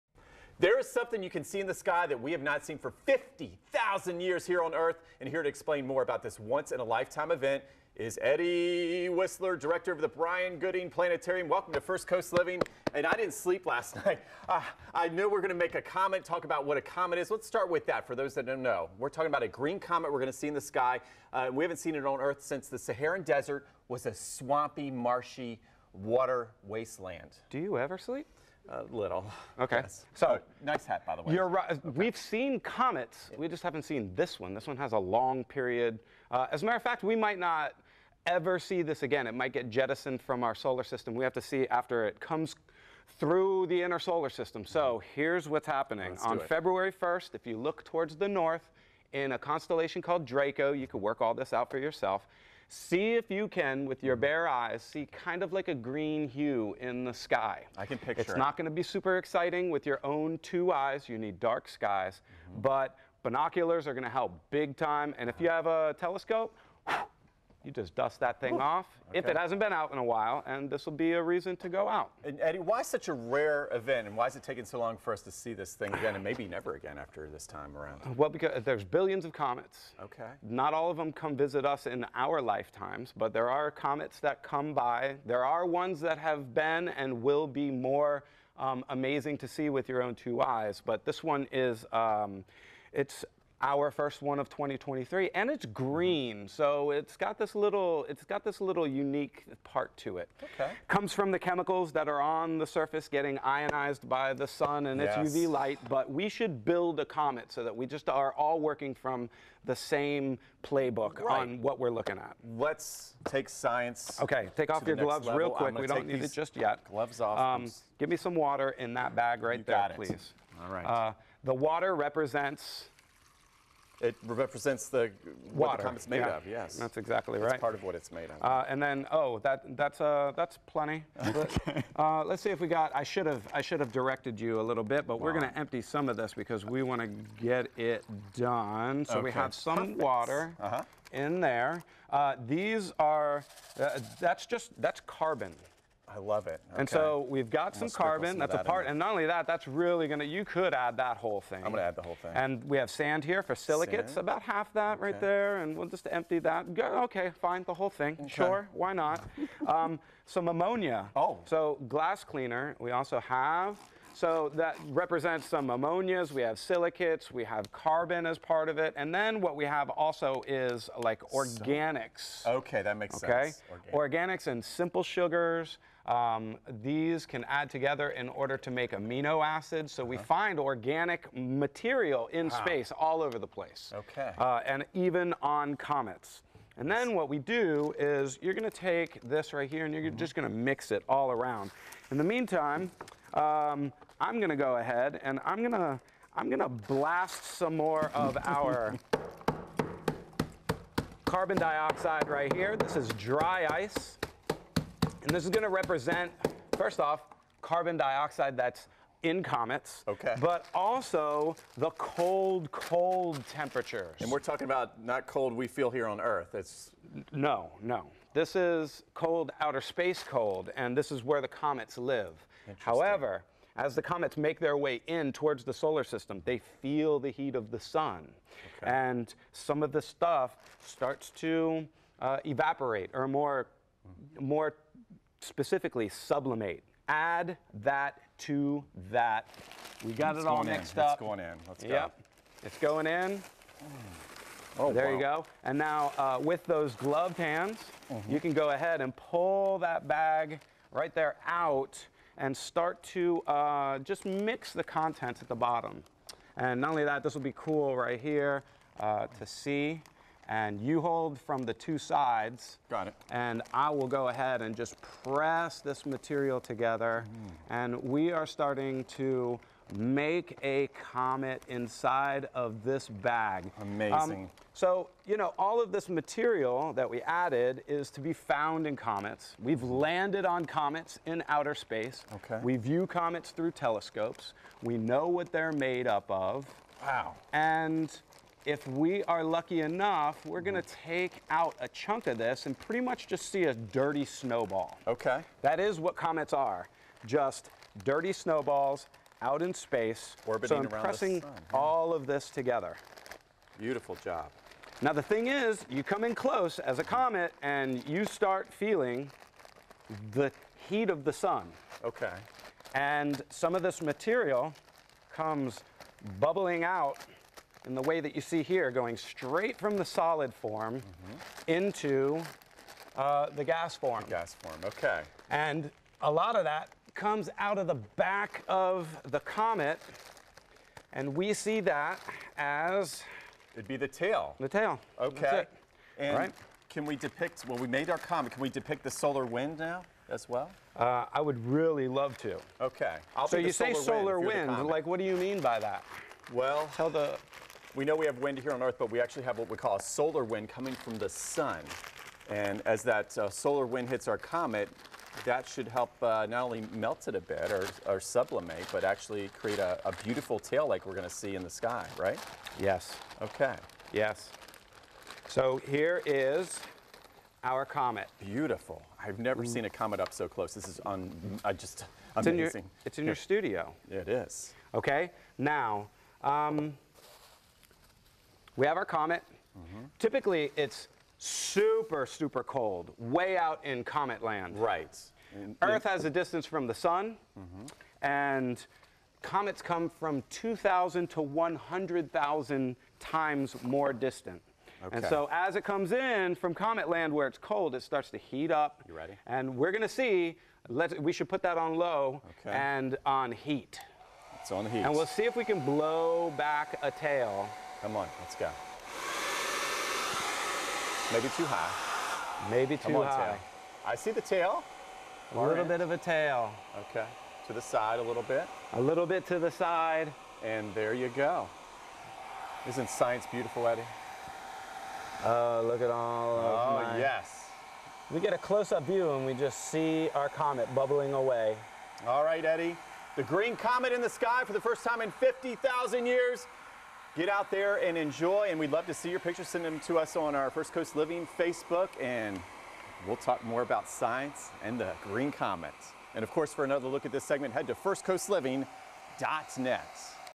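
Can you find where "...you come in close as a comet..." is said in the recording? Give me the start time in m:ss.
5:05.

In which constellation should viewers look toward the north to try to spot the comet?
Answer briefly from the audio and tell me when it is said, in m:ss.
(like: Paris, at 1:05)
Draco, at 0:50.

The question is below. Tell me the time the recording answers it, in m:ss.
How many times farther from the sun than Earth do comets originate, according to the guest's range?
6:30.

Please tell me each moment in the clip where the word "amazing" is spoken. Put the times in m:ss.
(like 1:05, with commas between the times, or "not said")
1:28, 4:33, 6:12.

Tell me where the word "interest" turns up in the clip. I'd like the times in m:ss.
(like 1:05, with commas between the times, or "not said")
not said.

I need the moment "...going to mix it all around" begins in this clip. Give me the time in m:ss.
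3:10.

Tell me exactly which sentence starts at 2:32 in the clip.
And we have sand here for silicates, sand?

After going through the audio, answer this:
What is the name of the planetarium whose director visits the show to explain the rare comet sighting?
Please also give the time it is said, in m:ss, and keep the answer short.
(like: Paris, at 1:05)
Bryan-Gooding Planetarium, at 0:10.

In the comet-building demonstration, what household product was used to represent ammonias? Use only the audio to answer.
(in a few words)
glass cleaner.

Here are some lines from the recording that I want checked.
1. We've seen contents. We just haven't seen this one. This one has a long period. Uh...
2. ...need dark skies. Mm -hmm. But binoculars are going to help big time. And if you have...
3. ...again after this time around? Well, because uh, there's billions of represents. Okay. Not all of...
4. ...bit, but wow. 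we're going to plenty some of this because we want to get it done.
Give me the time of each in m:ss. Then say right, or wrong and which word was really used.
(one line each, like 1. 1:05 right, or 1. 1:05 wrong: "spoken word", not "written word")
1. 0:31 wrong: "comets", not "contents"
2. 1:01 right
3. 1:16 wrong: "comets", not "represents"
4. 2:14 wrong: "empty", not "plenty".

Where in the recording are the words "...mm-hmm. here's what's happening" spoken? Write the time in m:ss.
0:45.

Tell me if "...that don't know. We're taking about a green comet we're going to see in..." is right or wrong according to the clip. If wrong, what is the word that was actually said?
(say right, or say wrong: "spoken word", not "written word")
wrong: "talking", not "taking".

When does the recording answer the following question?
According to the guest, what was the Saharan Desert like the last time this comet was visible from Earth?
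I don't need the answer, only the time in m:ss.
0:24.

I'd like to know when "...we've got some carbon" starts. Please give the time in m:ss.
2:27.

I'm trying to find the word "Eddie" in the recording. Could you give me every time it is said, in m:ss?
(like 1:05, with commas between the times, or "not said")
0:08, 1:12, 7:03, 7:12.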